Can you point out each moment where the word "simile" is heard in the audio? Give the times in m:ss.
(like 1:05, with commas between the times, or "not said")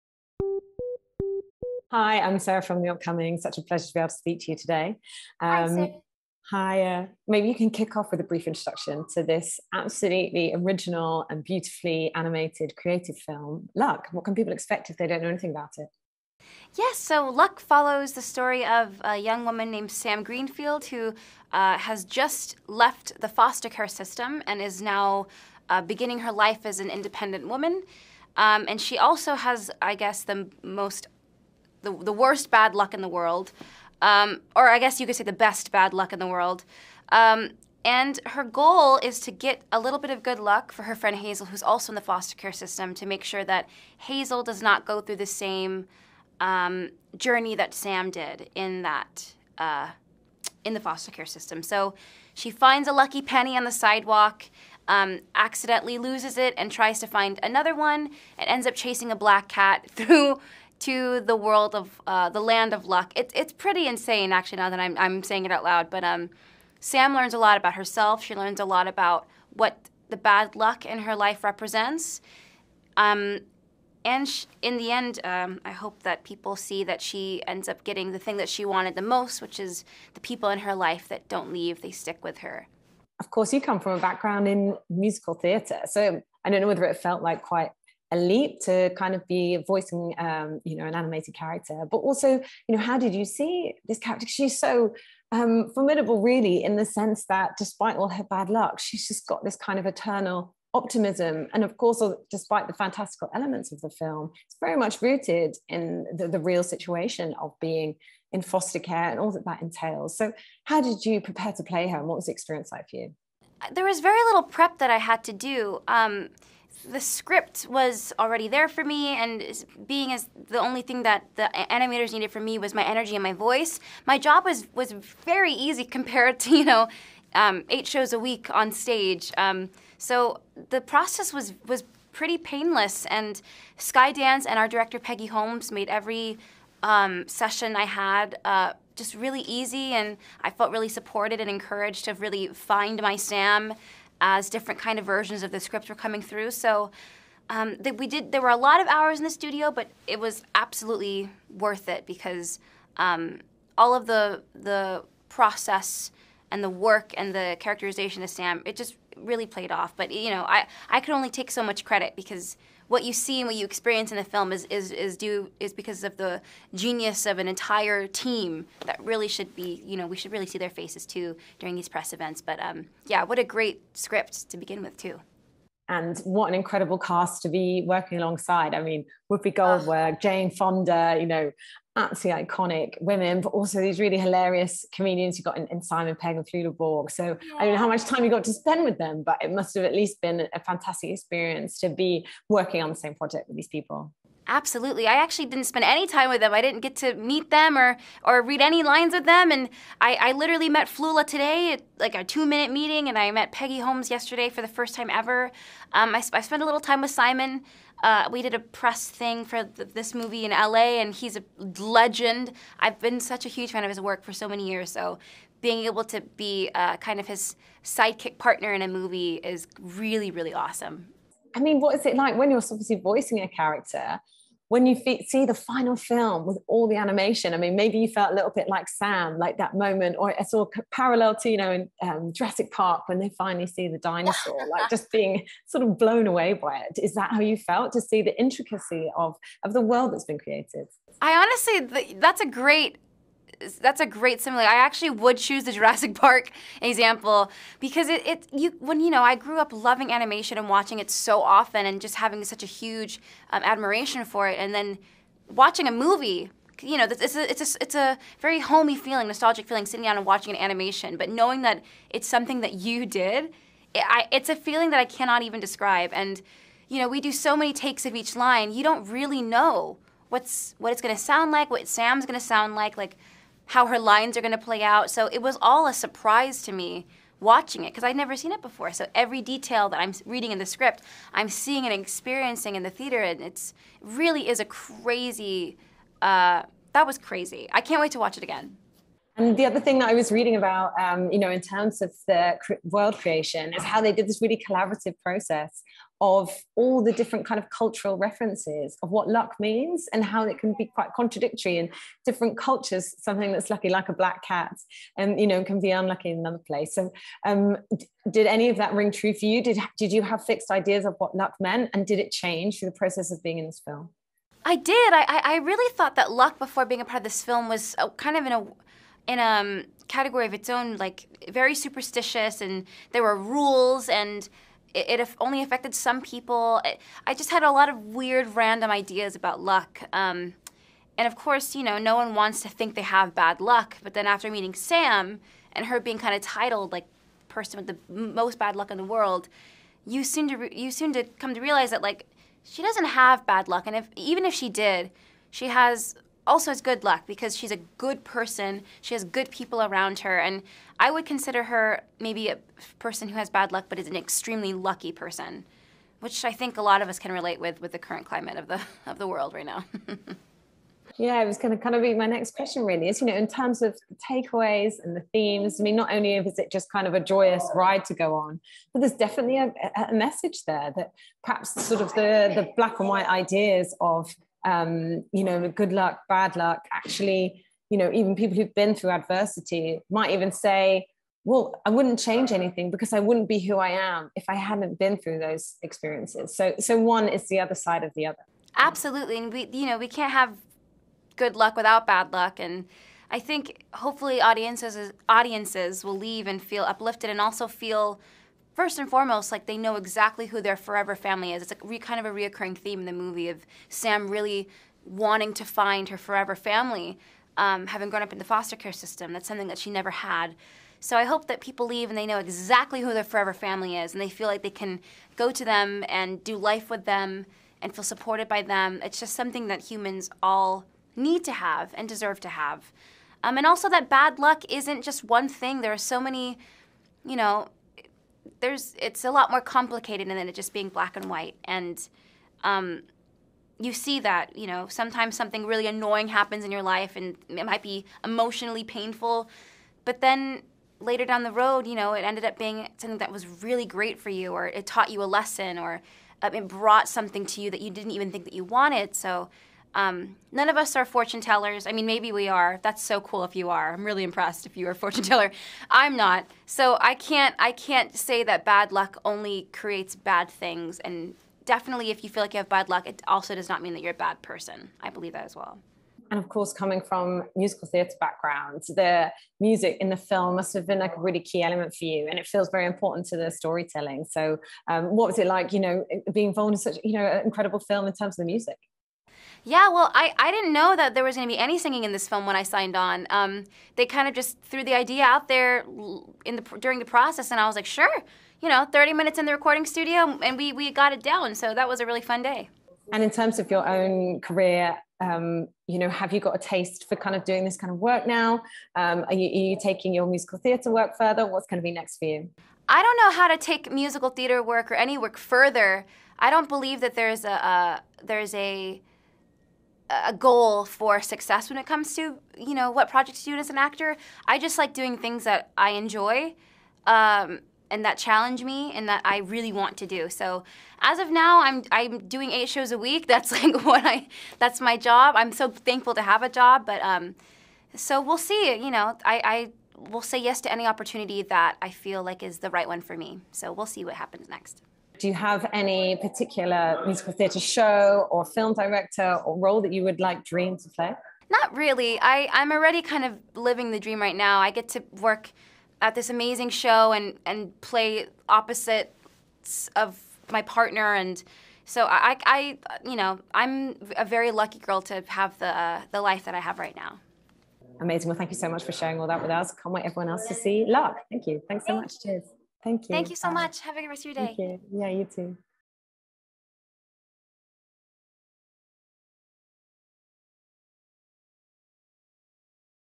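4:04.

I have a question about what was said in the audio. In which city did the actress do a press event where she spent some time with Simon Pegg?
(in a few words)
LA.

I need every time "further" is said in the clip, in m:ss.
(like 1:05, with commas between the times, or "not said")
8:21, 8:25.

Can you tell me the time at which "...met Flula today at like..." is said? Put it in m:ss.
3:20.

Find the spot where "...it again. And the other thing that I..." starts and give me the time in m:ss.
4:48.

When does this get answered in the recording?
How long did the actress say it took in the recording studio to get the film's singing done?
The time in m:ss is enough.
8:08.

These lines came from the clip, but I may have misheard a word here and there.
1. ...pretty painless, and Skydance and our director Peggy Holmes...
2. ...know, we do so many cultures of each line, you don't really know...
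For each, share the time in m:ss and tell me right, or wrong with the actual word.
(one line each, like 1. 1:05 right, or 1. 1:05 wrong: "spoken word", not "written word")
1. 2:12 right
2. 4:26 wrong: "takes", not "cultures".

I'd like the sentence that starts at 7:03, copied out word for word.
Um, and also that bad luck isn't just one thing.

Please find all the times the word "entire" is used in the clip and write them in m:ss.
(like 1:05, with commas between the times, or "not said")
2:47.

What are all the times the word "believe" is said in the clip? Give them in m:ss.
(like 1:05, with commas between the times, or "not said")
7:45, 8:26.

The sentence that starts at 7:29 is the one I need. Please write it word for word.
So um, none of us are fortune tellers.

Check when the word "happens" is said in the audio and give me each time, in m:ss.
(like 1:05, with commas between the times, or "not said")
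7:16, 8:54.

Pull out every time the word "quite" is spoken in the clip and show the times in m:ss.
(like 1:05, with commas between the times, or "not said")
1:27, 5:00.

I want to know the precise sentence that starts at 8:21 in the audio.
What's going to be next for you?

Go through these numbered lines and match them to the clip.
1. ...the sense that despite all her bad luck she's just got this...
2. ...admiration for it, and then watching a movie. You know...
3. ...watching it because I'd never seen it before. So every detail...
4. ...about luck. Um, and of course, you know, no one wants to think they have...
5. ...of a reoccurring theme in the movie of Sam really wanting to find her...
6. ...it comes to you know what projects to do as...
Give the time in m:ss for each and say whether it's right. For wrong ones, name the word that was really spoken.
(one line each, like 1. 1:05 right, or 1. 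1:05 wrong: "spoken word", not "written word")
1. 1:36 right
2. 4:13 right
3. 4:37 right
4. 5:29 right
5. 6:42 right
6. 8:31 right.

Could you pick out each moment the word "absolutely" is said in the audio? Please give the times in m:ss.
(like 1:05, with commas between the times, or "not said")
0:09, 2:30, 3:01, 3:14, 6:28.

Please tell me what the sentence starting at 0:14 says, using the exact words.
What can people expect if they don't know anything about it?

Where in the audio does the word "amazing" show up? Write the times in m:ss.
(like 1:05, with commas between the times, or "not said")
9:06, 9:17.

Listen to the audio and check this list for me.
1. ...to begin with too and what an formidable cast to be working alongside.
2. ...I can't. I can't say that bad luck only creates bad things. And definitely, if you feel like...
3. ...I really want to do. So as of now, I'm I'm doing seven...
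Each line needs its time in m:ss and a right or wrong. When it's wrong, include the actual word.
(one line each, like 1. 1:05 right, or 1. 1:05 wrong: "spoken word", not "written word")
1. 2:54 wrong: "incredible", not "formidable"
2. 7:37 right
3. 8:39 wrong: "eight", not "seven".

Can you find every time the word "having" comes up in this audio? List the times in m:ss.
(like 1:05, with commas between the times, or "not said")
4:12, 6:47.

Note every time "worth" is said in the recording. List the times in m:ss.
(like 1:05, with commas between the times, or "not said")
2:31.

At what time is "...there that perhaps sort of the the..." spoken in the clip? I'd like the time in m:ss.
6:10.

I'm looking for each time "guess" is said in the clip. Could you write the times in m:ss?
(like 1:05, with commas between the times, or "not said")
0:29, 0:34.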